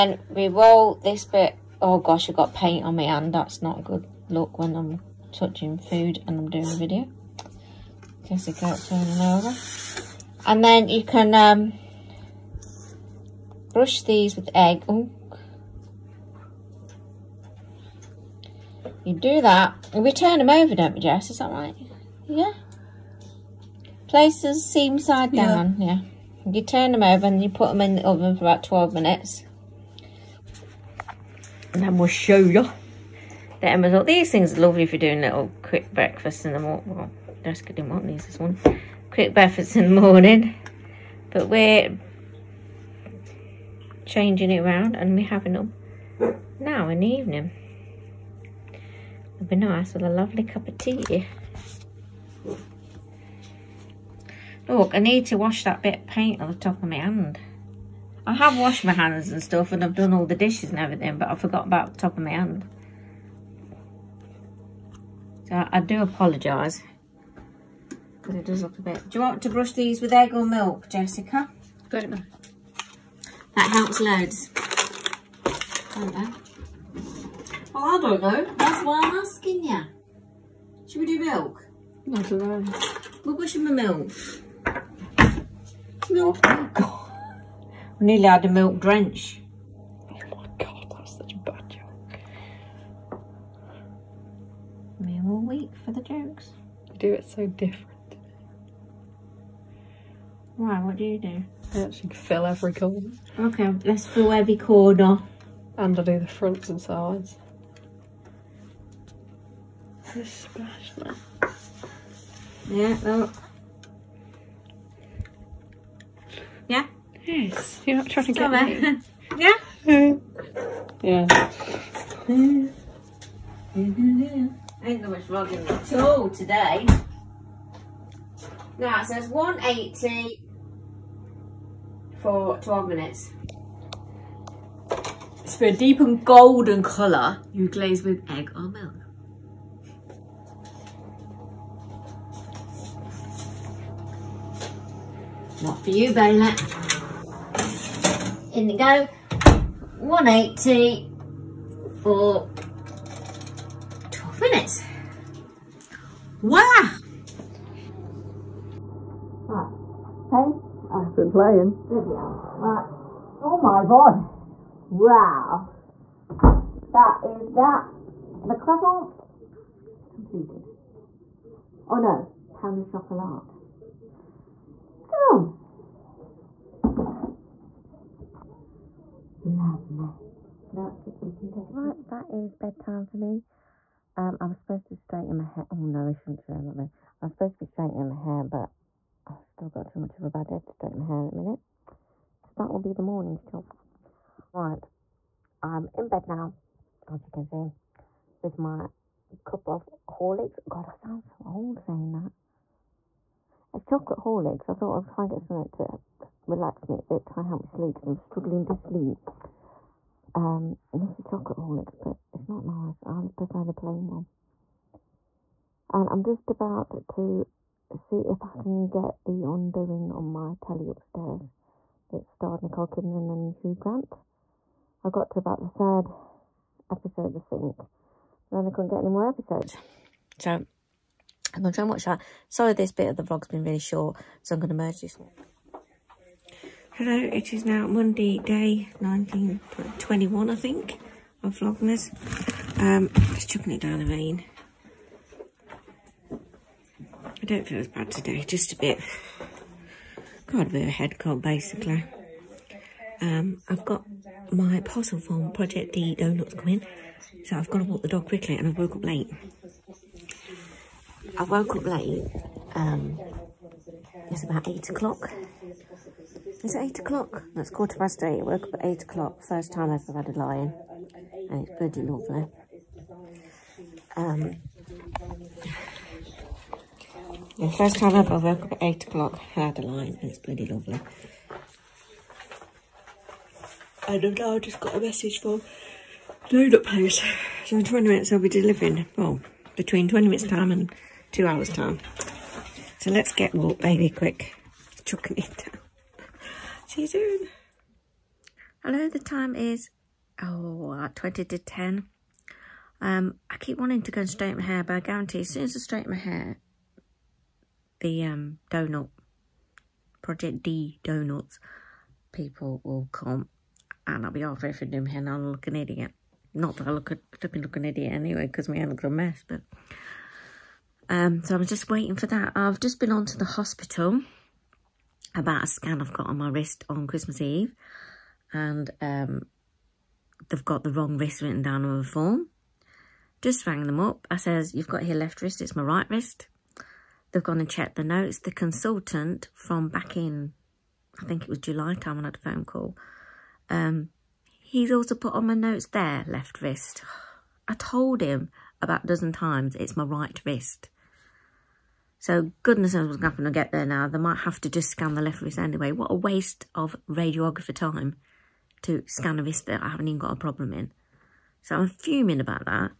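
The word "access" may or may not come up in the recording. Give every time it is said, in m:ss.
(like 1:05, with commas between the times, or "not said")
not said.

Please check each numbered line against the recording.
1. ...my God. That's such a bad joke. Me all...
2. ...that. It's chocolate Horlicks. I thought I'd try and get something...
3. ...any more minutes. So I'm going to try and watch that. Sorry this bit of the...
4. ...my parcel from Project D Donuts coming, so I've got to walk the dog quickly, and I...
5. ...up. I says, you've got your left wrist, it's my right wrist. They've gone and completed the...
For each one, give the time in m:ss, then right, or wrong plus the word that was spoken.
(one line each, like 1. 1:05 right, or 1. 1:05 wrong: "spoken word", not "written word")
1. 1:30 right
2. 3:22 right
3. 3:49 wrong: "episodes", not "minutes"
4. 4:14 right
5. 5:33 wrong: "checked", not "completed".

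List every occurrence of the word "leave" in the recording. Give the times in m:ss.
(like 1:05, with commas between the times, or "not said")
not said.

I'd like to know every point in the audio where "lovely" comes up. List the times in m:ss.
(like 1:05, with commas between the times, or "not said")
0:34, 0:50, 4:32, 4:40.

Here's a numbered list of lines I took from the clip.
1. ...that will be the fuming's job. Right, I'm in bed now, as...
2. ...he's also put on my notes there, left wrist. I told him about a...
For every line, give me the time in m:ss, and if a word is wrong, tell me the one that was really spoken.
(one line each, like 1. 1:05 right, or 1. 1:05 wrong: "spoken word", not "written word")
1. 3:12 wrong: "morning", not "fuming"
2. 5:44 right.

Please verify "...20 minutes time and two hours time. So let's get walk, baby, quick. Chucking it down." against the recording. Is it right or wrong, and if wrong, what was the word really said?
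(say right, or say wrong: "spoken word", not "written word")
right.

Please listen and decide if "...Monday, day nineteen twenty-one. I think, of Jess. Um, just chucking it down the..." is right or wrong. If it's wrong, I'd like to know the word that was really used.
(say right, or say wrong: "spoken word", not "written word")
wrong: "Vlogmas", not "Jess".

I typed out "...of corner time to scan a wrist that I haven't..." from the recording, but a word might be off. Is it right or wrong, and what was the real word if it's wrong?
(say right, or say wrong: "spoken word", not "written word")
wrong: "radiographer", not "corner".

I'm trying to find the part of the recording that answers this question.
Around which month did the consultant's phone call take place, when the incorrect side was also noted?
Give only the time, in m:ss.
5:41.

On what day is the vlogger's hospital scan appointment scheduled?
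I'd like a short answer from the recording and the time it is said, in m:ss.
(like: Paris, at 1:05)
Christmas Eve, at 5:27.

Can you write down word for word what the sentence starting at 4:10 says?
Got a bit of a head cold, basically.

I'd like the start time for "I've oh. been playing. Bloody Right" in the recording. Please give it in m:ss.
2:40.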